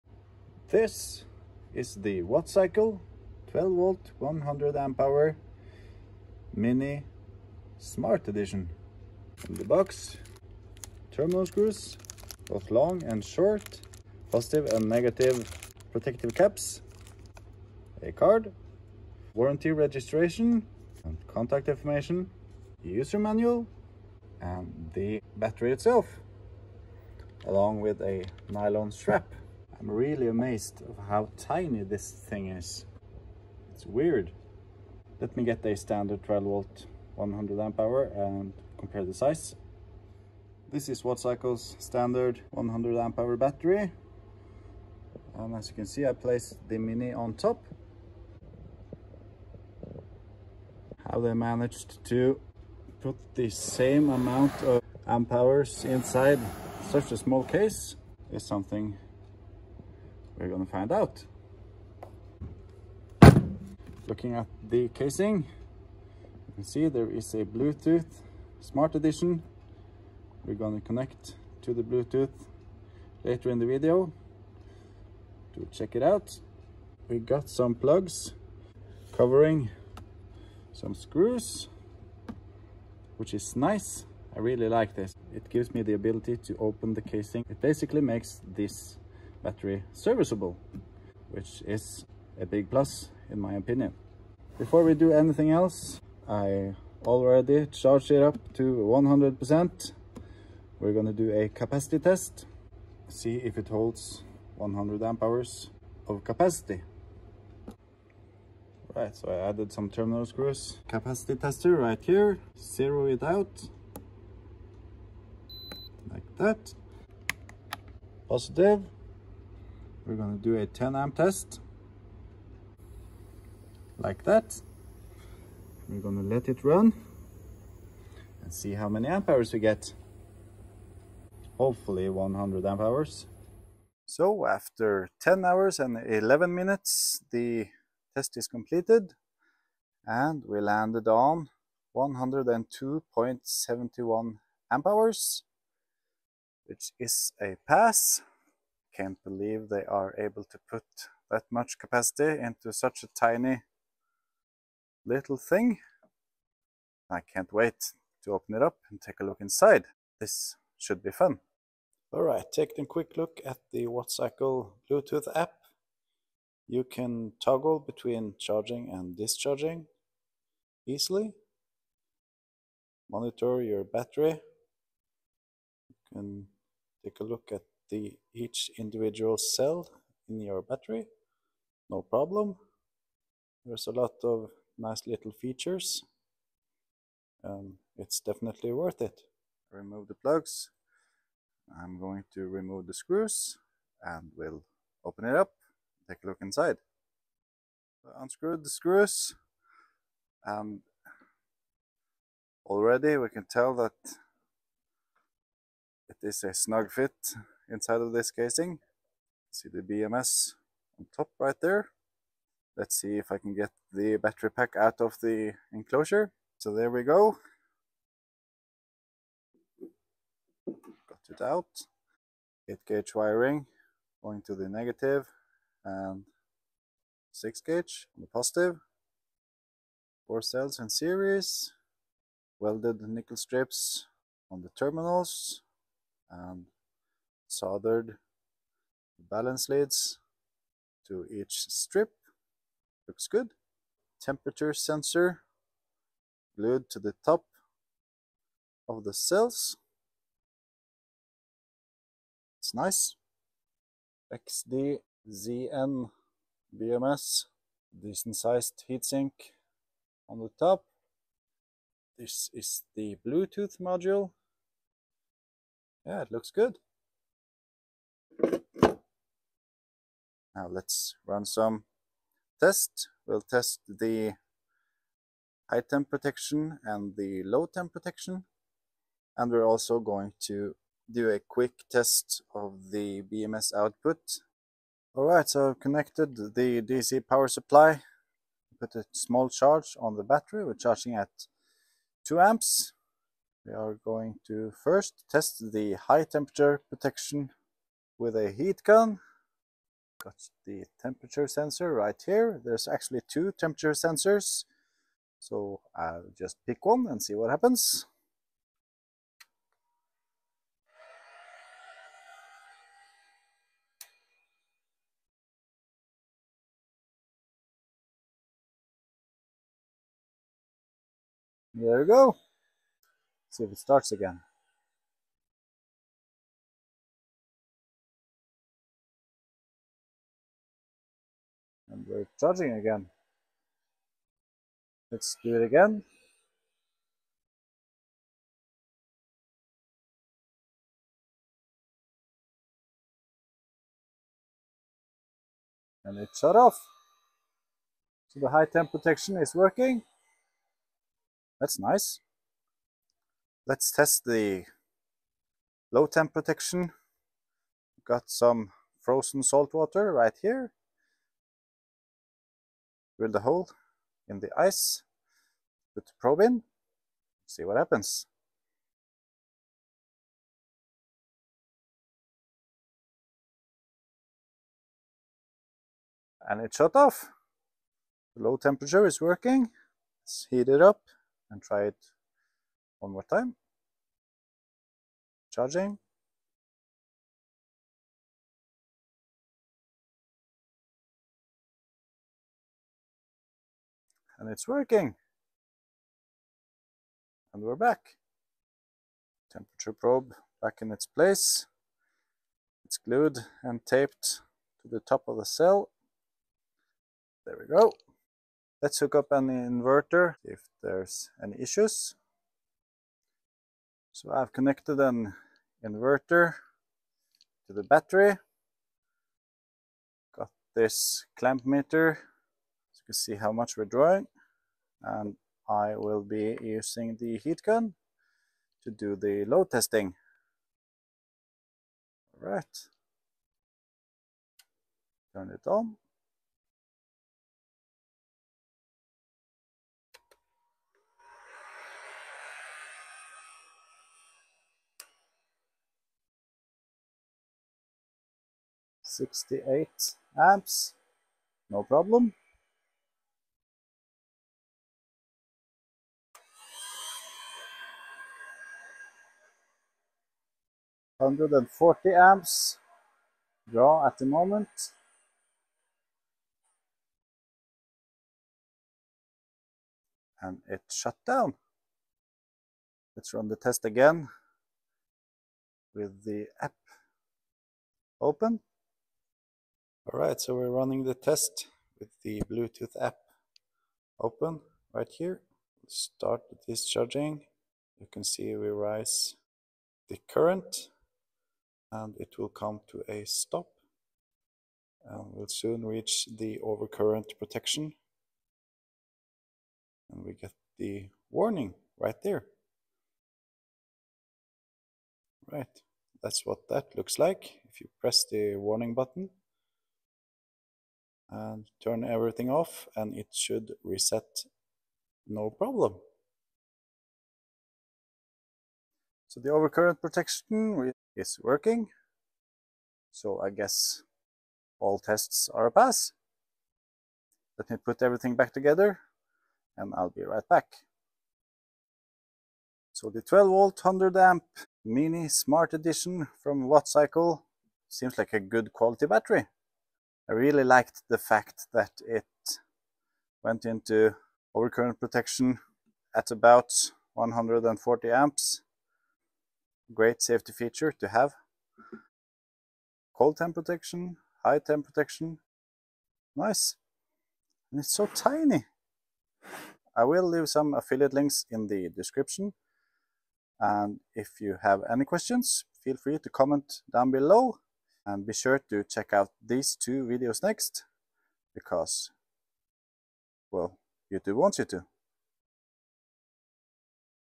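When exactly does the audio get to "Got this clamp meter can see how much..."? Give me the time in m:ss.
7:00.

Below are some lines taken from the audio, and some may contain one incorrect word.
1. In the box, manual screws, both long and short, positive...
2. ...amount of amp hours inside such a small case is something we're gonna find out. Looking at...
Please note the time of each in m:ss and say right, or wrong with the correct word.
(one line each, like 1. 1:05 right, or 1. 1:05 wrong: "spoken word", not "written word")
1. 0:09 wrong: "terminal", not "manual"
2. 0:54 right.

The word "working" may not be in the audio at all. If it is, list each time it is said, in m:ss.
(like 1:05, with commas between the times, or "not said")
5:49, 6:19, 6:34, 8:41.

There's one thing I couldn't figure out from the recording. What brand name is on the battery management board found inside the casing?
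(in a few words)
XDZN.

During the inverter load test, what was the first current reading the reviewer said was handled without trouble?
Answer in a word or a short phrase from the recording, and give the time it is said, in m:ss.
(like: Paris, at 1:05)
68 amps, at 7:29.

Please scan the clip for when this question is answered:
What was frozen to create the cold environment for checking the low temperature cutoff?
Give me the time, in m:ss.
5:59.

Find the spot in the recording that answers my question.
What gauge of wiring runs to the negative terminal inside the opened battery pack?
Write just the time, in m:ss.
3:42.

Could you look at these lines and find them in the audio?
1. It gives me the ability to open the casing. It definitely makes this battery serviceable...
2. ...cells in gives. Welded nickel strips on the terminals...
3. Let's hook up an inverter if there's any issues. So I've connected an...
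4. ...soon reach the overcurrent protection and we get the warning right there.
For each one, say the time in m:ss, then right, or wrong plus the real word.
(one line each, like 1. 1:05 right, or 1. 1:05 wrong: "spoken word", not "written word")
1. 1:25 wrong: "basically", not "definitely"
2. 3:50 wrong: "series", not "gives"
3. 6:48 right
4. 8:15 right.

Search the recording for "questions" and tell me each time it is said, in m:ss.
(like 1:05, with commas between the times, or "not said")
9:25.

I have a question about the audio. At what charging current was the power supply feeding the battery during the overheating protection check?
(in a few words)
2 amps.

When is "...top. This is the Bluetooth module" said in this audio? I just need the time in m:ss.
4:20.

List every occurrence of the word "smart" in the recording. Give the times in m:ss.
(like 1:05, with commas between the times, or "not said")
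0:07, 1:08, 8:55.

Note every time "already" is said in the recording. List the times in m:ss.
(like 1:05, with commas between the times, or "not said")
1:37, 3:22.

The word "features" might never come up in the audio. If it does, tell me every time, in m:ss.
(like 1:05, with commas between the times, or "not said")
3:05, 9:10.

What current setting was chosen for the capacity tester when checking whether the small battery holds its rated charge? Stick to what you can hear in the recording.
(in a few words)
10 amps.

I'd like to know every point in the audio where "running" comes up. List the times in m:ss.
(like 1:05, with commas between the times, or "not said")
8:00.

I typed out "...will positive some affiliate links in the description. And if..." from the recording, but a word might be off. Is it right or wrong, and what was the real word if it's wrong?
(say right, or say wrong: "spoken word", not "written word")
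wrong: "leave", not "positive".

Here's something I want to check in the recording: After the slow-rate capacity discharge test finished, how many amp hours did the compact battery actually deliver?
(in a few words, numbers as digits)
102.71 amp hours.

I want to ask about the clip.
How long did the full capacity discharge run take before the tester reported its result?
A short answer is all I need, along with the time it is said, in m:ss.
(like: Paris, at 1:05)
10 hours and 11 minutes, at 2:15.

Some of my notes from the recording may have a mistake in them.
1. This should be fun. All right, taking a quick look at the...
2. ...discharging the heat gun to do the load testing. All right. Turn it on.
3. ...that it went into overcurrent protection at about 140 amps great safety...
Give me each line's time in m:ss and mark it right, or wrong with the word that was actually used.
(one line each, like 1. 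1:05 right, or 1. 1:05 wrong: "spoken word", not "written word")
1. 2:40 right
2. 7:06 wrong: "using", not "discharging"
3. 9:01 right.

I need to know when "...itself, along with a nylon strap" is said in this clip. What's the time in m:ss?
0:25.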